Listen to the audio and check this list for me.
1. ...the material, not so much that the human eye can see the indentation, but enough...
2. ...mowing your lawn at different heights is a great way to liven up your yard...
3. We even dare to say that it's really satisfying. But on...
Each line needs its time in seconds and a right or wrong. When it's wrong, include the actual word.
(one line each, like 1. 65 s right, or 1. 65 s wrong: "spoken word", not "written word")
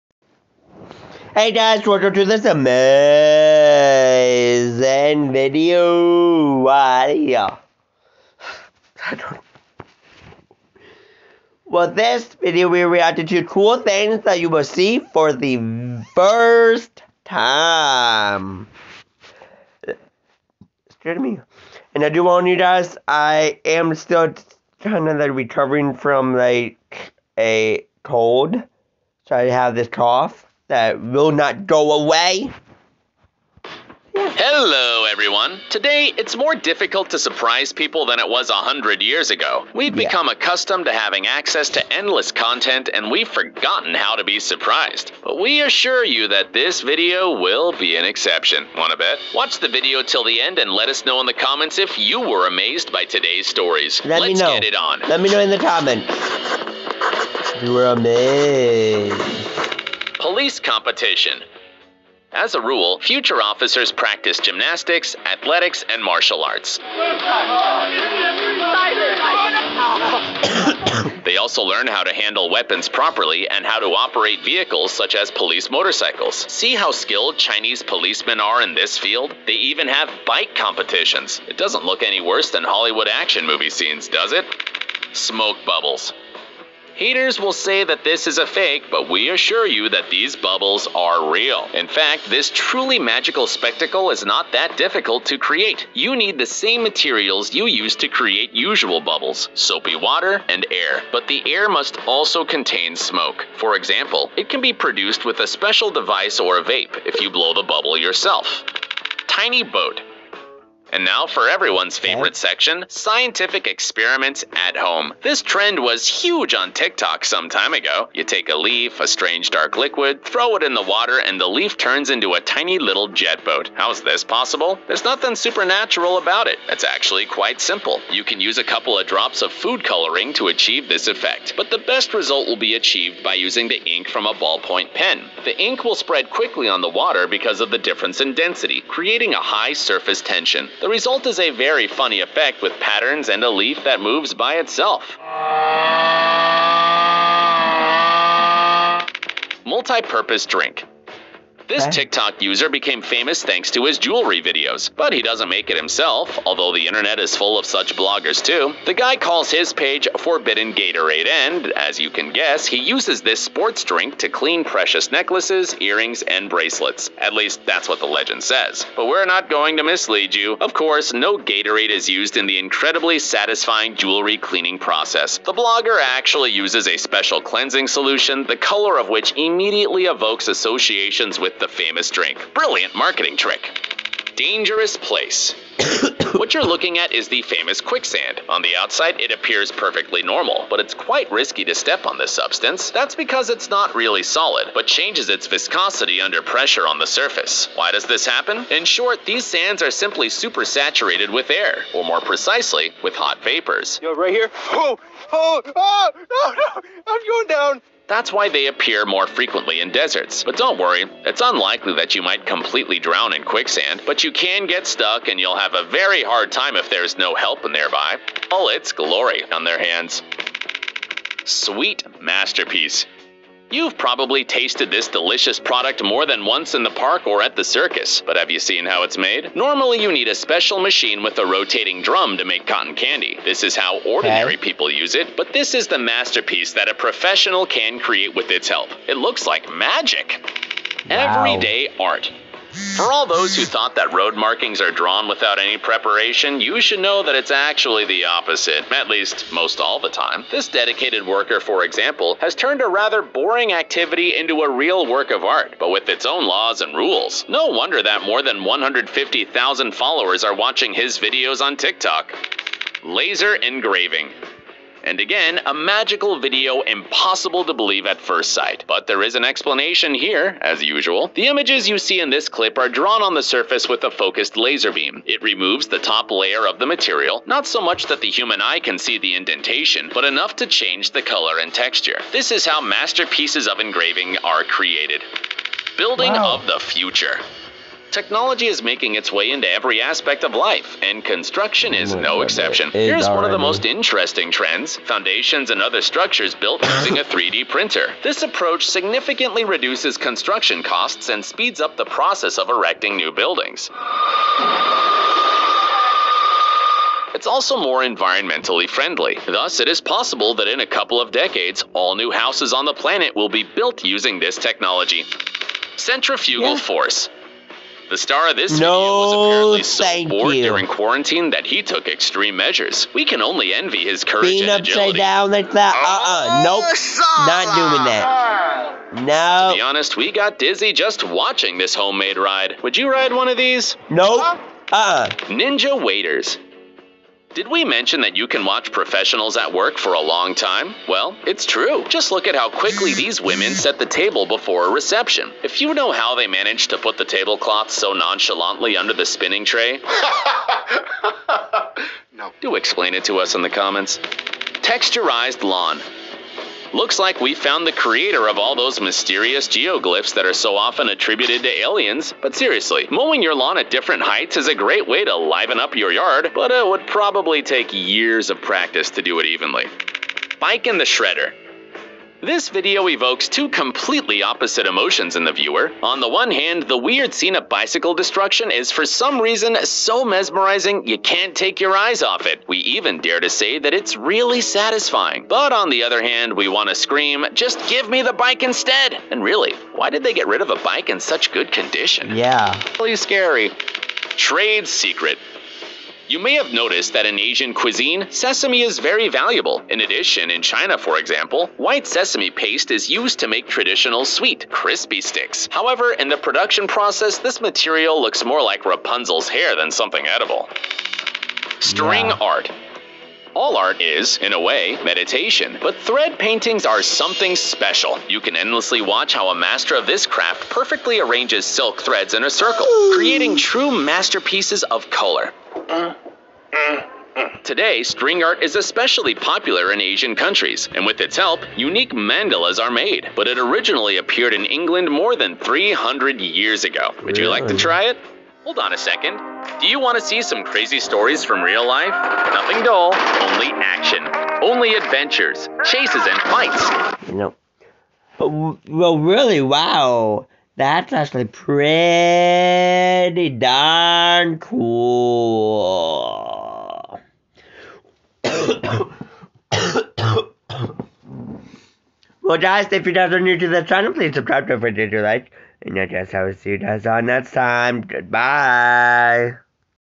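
1. 276 s right
2. 363 s right
3. 382 s right.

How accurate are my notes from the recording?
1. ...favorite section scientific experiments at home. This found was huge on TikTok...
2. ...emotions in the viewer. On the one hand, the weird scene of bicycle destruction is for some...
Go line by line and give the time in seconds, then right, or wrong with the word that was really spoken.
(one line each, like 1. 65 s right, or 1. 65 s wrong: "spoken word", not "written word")
1. 111 s wrong: "trend", not "found"
2. 374 s right.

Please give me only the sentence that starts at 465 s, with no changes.
And I guess I will see you guys on next time.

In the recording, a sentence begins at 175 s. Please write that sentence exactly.
The blogger actually uses a special cleansing solution, the color of which immediately evokes associations with the famous drink.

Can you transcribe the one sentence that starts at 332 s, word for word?
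Would you ride one of these?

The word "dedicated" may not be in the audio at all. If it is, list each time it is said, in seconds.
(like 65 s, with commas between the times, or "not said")
250 s.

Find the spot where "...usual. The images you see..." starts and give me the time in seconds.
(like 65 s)
270 s.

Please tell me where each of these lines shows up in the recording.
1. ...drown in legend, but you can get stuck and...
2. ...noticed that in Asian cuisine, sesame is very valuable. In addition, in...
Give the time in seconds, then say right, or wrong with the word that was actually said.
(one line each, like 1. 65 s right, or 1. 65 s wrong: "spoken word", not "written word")
1. 212 s wrong: "quicksand", not "legend"
2. 396 s right.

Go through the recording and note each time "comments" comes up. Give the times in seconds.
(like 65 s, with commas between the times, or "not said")
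51 s, 55 s, 353 s.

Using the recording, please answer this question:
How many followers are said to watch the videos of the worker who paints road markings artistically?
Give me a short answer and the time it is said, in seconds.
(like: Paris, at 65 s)
150,000, at 258 s.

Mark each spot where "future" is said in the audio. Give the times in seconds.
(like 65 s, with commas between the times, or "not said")
63 s, 286 s.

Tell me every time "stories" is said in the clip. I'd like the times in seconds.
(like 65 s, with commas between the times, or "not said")
53 s, 440 s.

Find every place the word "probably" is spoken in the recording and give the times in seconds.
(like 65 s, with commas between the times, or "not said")
223 s, 367 s.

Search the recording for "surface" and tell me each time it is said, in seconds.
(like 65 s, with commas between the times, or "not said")
139 s, 197 s, 273 s.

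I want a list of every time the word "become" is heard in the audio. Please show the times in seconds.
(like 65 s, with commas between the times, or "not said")
40 s.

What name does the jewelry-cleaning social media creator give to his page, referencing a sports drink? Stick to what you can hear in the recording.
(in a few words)
Forbidden Gatorade.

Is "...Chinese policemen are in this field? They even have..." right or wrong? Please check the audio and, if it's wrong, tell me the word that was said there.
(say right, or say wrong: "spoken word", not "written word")
right.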